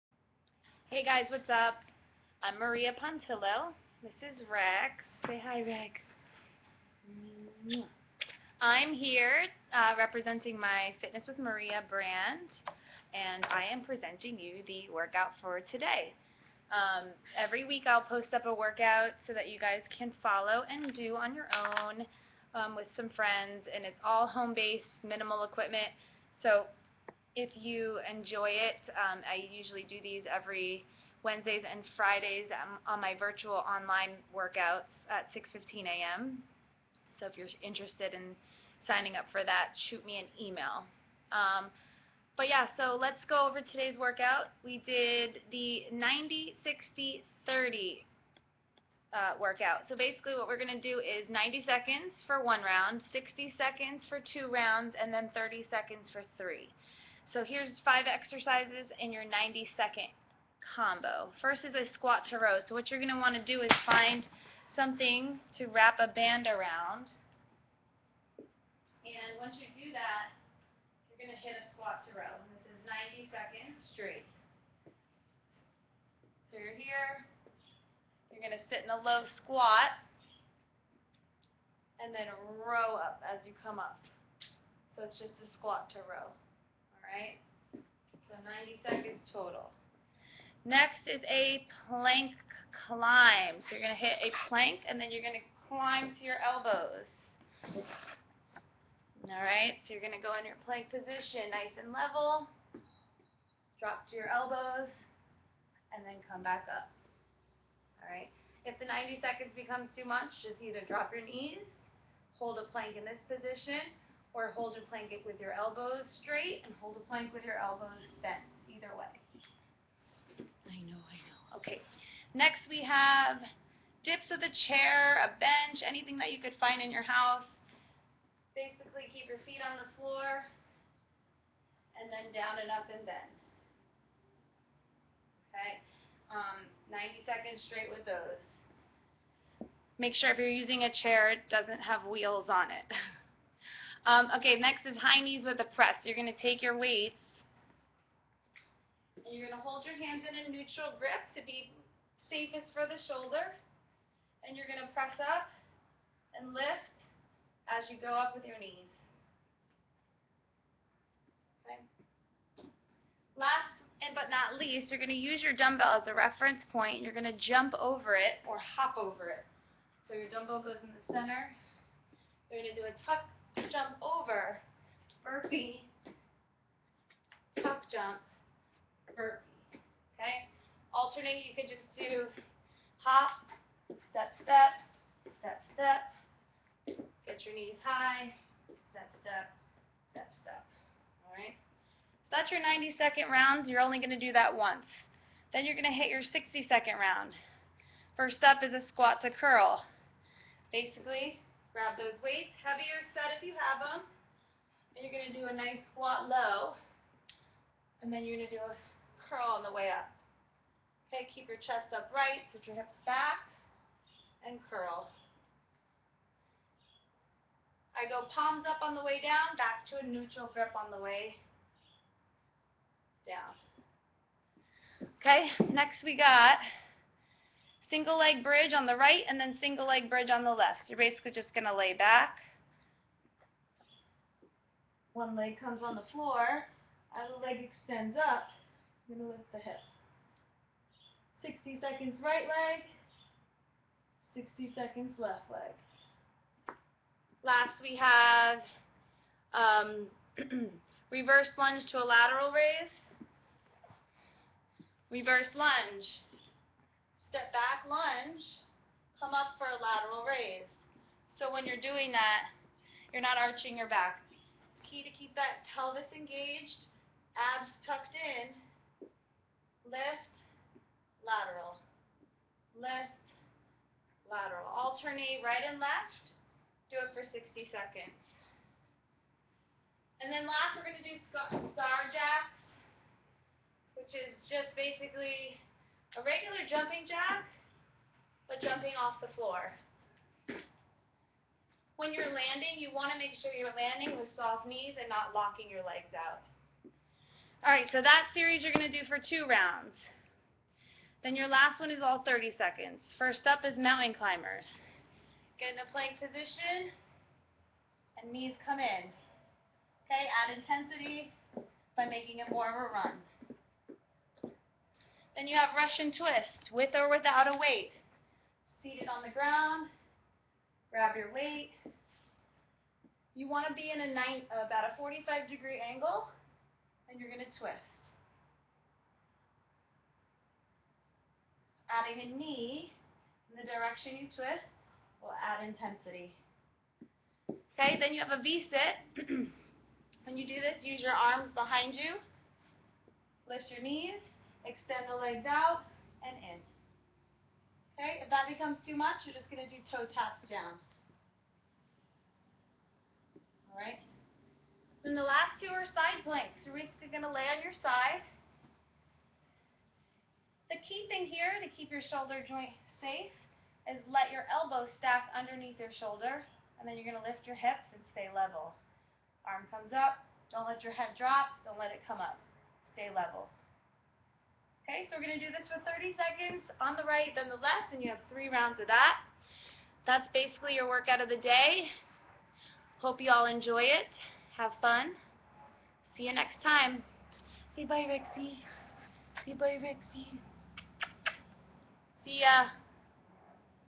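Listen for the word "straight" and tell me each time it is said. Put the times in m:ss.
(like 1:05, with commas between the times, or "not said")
1:13, 1:56, 2:17.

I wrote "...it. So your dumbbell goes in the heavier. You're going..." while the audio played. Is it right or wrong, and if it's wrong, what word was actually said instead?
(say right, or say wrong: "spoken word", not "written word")
wrong: "center", not "heavier".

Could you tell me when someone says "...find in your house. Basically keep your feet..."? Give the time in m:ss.
2:06.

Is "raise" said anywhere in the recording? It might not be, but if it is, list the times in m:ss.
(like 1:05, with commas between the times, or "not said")
4:12, 4:20.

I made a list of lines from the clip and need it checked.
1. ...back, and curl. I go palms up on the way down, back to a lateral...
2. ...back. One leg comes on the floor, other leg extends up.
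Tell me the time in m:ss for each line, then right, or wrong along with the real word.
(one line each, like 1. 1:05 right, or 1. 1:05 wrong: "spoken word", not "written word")
1. 3:33 wrong: "neutral", not "lateral"
2. 3:51 right.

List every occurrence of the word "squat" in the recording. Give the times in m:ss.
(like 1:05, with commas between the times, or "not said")
1:01, 1:11, 1:19, 1:25, 3:18, 3:25.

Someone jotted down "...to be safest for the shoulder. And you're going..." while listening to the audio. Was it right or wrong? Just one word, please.
right.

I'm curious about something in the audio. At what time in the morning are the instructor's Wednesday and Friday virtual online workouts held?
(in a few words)
6:15 a.m.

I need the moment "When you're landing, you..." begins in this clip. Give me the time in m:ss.
4:51.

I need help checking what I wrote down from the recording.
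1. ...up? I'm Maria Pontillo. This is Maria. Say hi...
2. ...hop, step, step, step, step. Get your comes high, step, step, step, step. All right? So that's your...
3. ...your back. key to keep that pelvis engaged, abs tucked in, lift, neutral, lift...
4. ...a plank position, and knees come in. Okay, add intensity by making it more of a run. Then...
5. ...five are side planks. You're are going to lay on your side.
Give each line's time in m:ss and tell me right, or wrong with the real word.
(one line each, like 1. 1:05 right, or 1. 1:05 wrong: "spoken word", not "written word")
1. 0:01 wrong: "Rex", not "Maria"
2. 3:02 wrong: "knees", not "comes"
3. 4:23 wrong: "lateral", not "neutral"
4. 5:05 right
5. 5:55 wrong: "two", not "five".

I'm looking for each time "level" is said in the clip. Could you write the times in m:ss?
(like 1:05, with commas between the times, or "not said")
1:41, 6:08, 6:13.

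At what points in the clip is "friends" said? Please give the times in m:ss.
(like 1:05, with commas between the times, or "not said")
0:23.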